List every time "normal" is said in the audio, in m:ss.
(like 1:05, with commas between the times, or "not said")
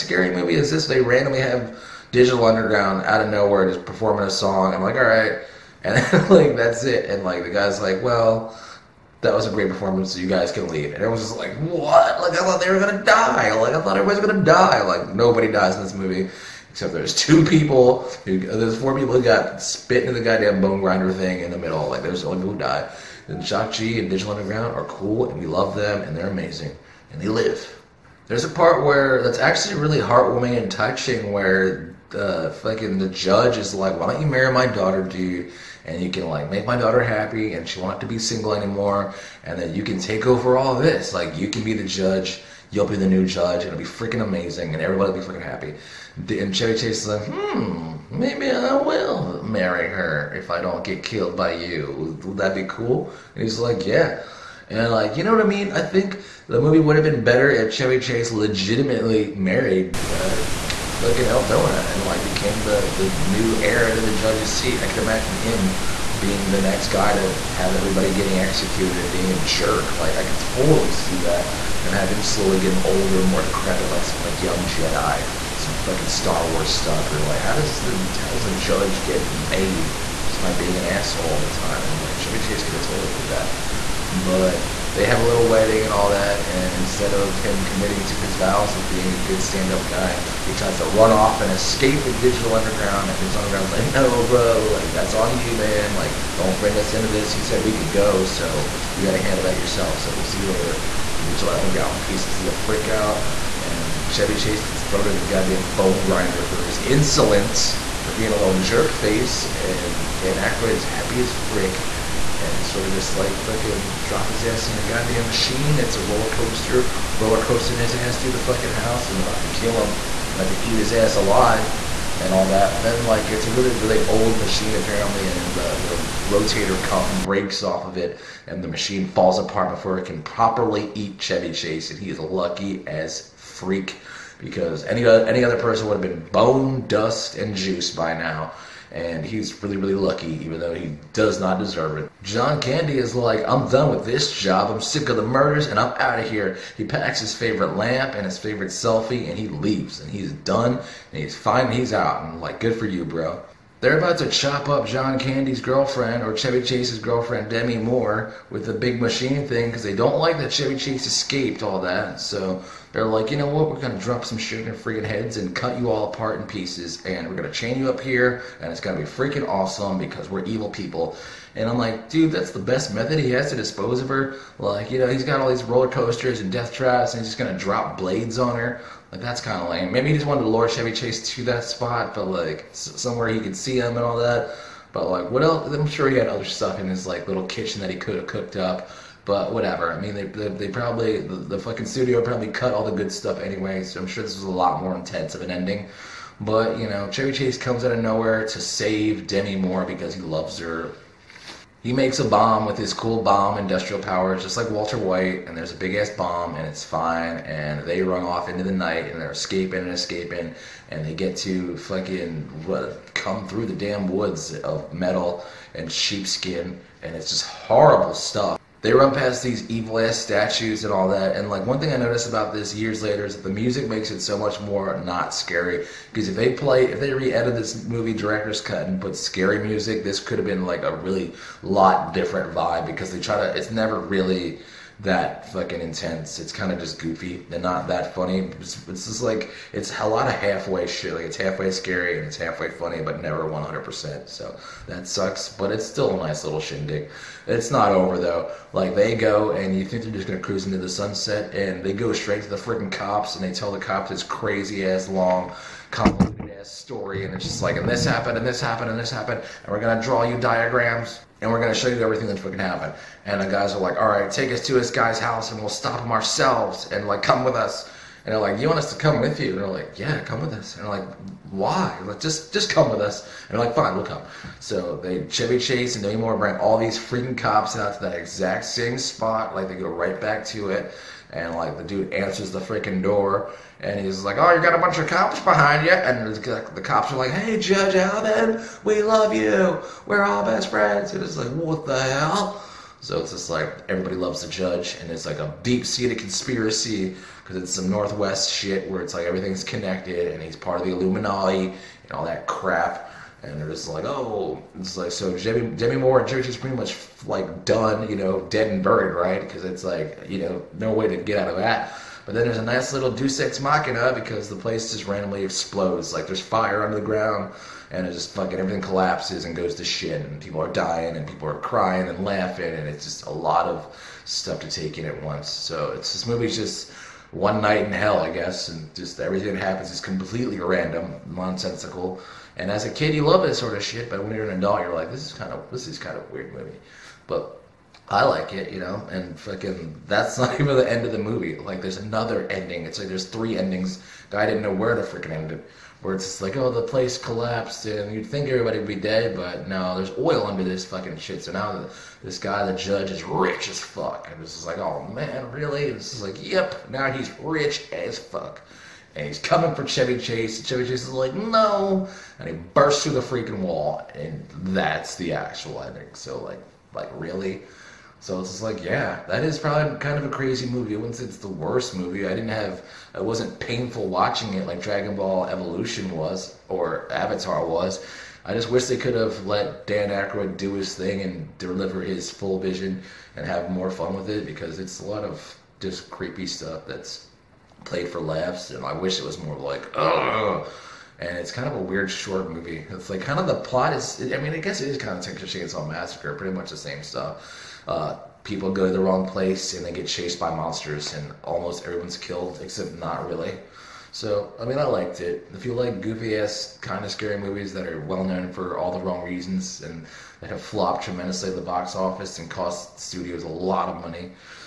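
not said.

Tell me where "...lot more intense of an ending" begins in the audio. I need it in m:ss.
3:14.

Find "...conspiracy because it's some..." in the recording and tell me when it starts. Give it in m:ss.
4:56.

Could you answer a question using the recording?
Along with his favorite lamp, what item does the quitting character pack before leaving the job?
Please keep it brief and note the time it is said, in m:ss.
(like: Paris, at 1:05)
his favorite selfie, at 2:28.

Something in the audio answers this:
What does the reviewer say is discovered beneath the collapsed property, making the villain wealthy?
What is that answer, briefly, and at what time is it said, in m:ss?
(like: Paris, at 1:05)
oil, at 5:50.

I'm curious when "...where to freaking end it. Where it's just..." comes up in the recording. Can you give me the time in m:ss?
5:44.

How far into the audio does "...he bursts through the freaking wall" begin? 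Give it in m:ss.
6:02.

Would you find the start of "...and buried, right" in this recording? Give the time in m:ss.
5:08.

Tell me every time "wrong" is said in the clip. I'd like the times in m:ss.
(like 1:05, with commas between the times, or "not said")
6:39, 6:49.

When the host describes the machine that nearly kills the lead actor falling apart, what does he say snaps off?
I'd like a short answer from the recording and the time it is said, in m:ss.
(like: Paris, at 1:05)
the rotator cuff, at 2:06.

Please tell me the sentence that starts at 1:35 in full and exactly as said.
Like, don't bring us into this.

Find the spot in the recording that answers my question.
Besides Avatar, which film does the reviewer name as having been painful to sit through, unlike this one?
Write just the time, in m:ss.
6:14.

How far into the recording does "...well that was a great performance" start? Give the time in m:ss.
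0:08.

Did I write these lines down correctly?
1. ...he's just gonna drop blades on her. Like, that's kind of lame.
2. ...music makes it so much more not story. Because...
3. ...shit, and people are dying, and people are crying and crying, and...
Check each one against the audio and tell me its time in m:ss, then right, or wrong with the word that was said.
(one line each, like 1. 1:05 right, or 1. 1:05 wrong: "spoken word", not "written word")
1. 2:57 right
2. 3:43 wrong: "scary", not "story"
3. 5:19 wrong: "laughing", not "crying".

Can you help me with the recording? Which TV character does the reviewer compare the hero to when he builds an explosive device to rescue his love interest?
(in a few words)
Walter White.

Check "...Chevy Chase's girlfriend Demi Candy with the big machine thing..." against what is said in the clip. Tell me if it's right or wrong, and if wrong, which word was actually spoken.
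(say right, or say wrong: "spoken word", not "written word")
wrong: "Moore", not "Candy".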